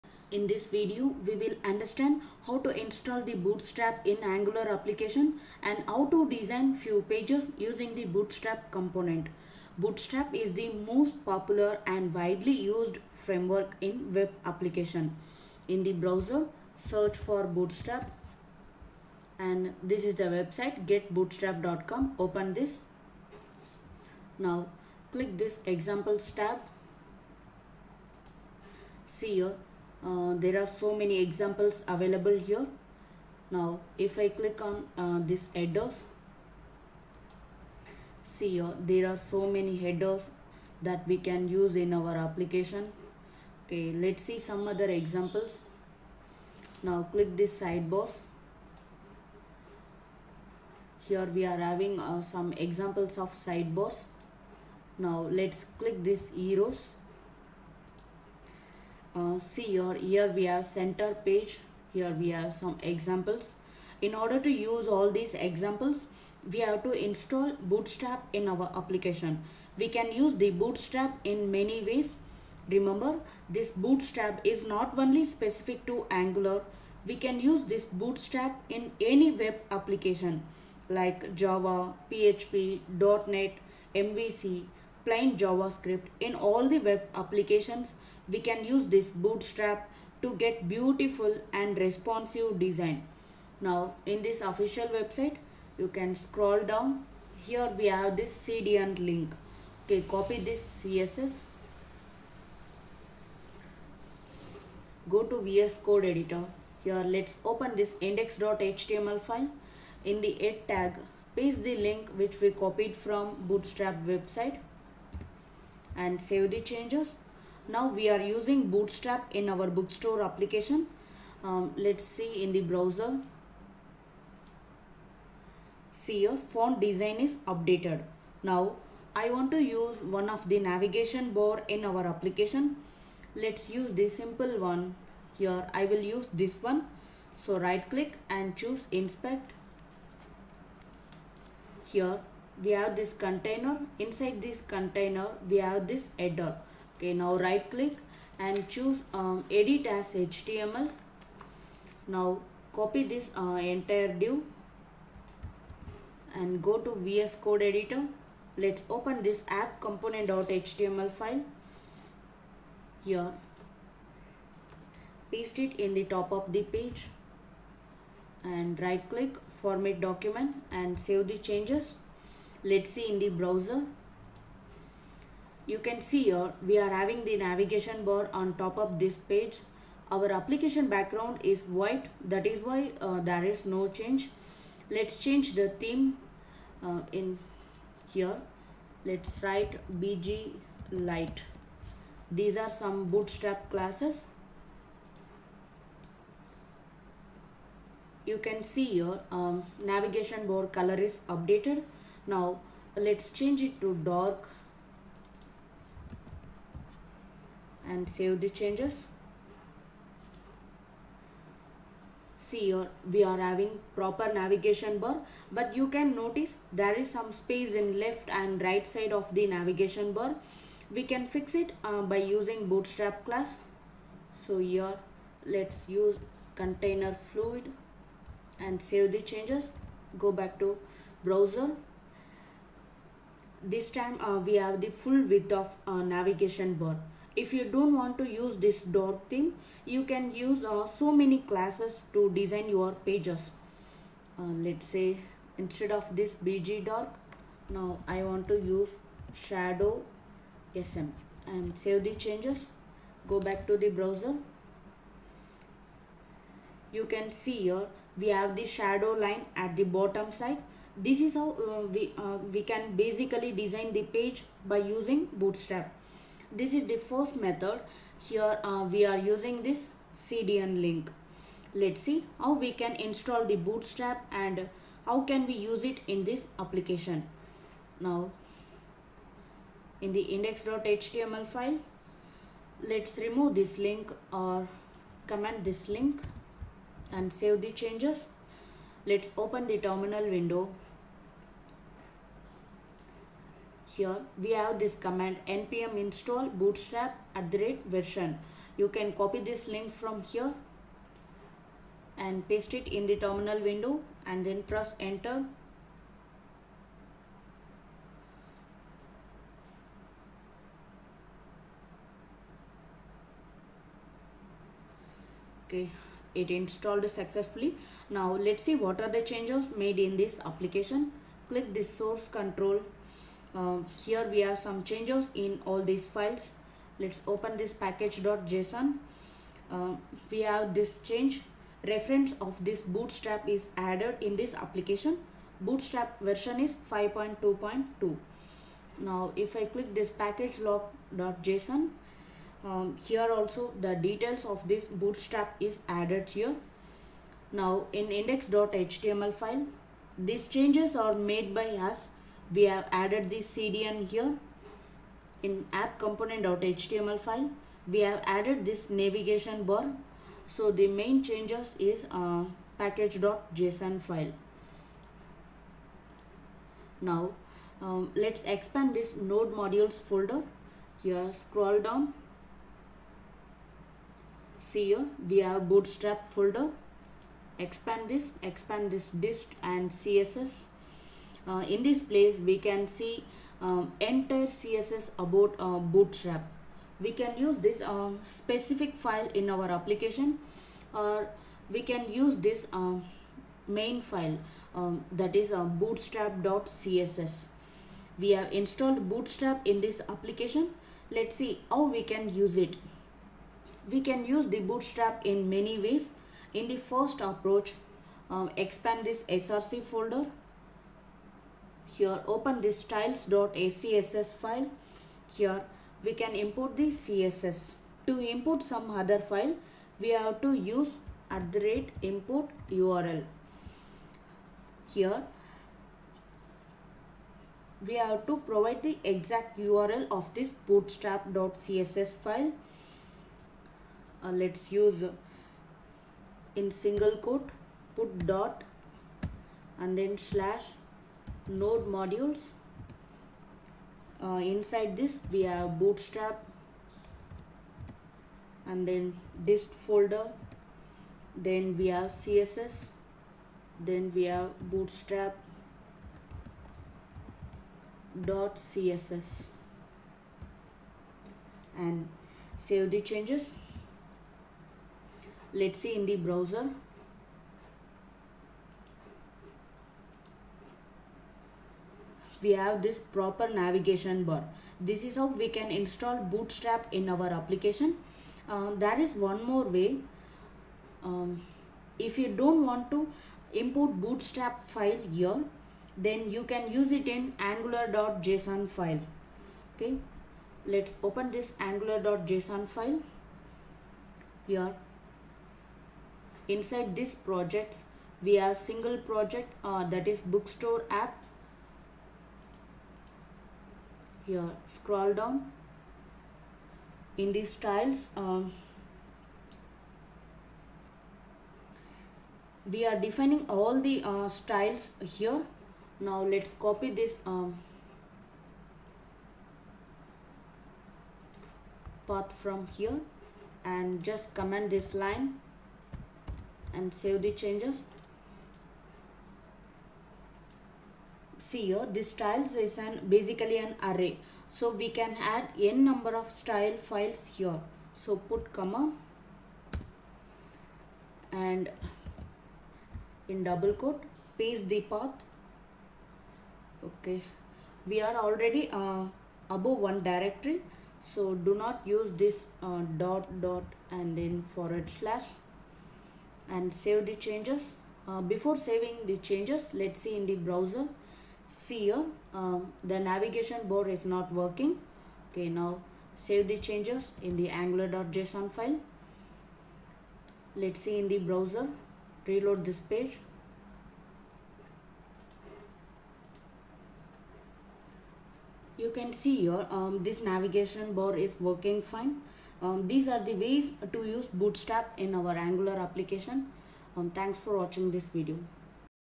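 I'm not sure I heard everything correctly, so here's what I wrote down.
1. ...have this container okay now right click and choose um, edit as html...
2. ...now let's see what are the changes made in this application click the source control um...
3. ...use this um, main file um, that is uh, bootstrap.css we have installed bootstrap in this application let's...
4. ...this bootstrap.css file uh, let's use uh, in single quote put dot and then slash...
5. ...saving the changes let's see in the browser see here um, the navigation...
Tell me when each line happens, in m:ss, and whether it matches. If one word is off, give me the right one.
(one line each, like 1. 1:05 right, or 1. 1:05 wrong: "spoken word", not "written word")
1. 2:25 wrong: "header", not "container"
2. 5:18 right
3. 6:32 right
4. 7:10 right
5. 9:18 right.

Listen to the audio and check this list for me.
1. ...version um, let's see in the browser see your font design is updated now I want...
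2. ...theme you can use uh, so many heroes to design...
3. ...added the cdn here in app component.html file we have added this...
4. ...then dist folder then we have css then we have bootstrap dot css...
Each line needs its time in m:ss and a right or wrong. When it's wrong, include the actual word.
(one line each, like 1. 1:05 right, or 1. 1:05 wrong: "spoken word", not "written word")
1. 2:00 wrong: "application", not "version"
2. 3:59 wrong: "classes", not "heroes"
3. 5:52 right
4. 7:28 right.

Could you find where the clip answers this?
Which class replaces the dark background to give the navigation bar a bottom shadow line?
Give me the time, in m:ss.
4:09.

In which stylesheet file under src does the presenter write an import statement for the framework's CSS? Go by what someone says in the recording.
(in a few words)
styles.scss.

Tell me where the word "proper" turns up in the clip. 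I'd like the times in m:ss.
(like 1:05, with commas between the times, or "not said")
3:33, 7:53.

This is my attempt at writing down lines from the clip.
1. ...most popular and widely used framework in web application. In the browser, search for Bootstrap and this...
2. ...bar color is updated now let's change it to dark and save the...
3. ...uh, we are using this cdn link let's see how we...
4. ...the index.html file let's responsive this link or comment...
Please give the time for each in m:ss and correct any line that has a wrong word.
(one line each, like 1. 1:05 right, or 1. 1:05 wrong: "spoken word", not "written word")
1. 0:10 right
2. 3:20 right
3. 4:28 right
4. 4:40 wrong: "remove", not "responsive".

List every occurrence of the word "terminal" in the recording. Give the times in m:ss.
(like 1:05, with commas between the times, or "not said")
4:49, 5:03.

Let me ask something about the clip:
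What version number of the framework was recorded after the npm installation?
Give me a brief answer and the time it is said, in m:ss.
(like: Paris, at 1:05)
5.2.2, at 5:36.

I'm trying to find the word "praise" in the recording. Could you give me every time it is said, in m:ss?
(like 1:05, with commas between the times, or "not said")
not said.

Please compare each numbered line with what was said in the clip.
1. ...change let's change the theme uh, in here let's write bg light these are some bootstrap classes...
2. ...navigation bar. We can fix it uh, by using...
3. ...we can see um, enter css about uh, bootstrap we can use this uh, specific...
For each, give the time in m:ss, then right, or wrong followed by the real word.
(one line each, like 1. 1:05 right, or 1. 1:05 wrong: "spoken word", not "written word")
1. 3:03 right
2. 3:39 right
3. 6:22 right.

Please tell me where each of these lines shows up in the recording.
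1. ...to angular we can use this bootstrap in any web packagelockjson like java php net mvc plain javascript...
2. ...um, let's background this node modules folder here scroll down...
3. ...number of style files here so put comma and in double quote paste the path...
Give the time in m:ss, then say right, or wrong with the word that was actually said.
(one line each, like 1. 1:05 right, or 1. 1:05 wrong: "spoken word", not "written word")
1. 1:15 wrong: "application", not "packagelockjson"
2. 6:07 wrong: "expand", not "background"
3. 8:55 right.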